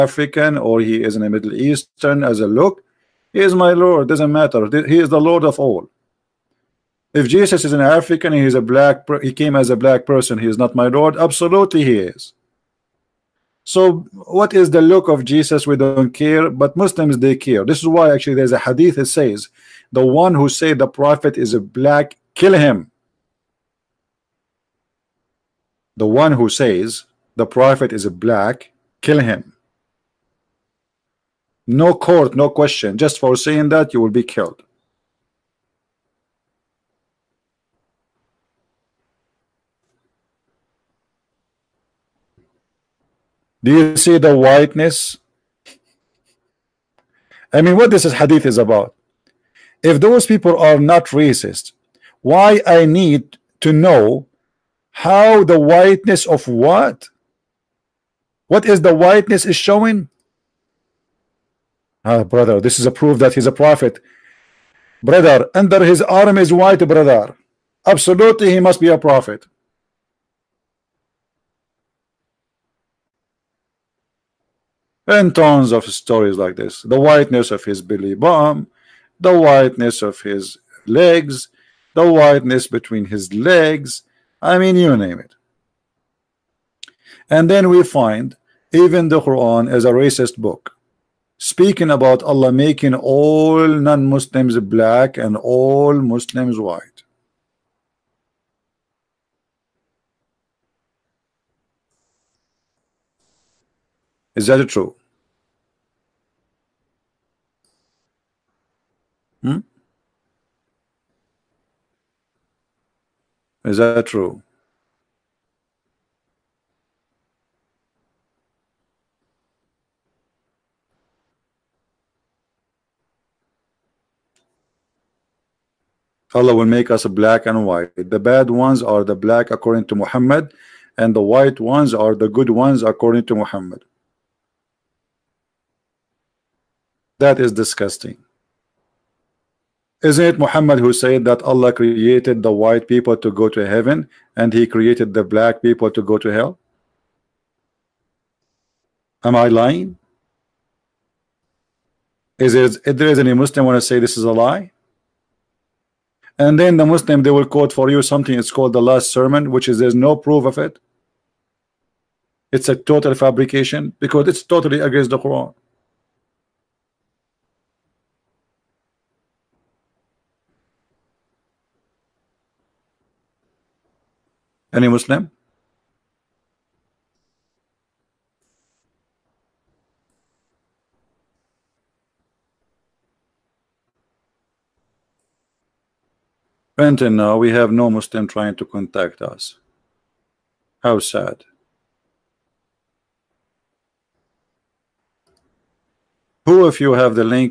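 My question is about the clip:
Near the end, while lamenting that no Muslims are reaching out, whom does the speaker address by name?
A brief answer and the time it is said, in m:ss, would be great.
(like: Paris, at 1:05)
Brenton, at 3:06.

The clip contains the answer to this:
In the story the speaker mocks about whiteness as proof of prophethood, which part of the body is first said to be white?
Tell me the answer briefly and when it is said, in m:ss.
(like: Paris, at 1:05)
Under his arm, at 1:05.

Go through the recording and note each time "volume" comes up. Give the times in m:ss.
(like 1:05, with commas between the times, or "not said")
not said.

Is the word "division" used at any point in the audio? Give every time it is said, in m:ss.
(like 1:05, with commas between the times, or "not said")
not said.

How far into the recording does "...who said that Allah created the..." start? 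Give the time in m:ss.
2:20.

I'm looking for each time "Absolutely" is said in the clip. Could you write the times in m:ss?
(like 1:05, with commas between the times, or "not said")
0:11, 1:07.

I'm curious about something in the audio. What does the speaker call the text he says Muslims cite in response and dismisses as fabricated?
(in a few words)
The last sermon.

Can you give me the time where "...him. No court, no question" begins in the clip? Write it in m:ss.
0:29.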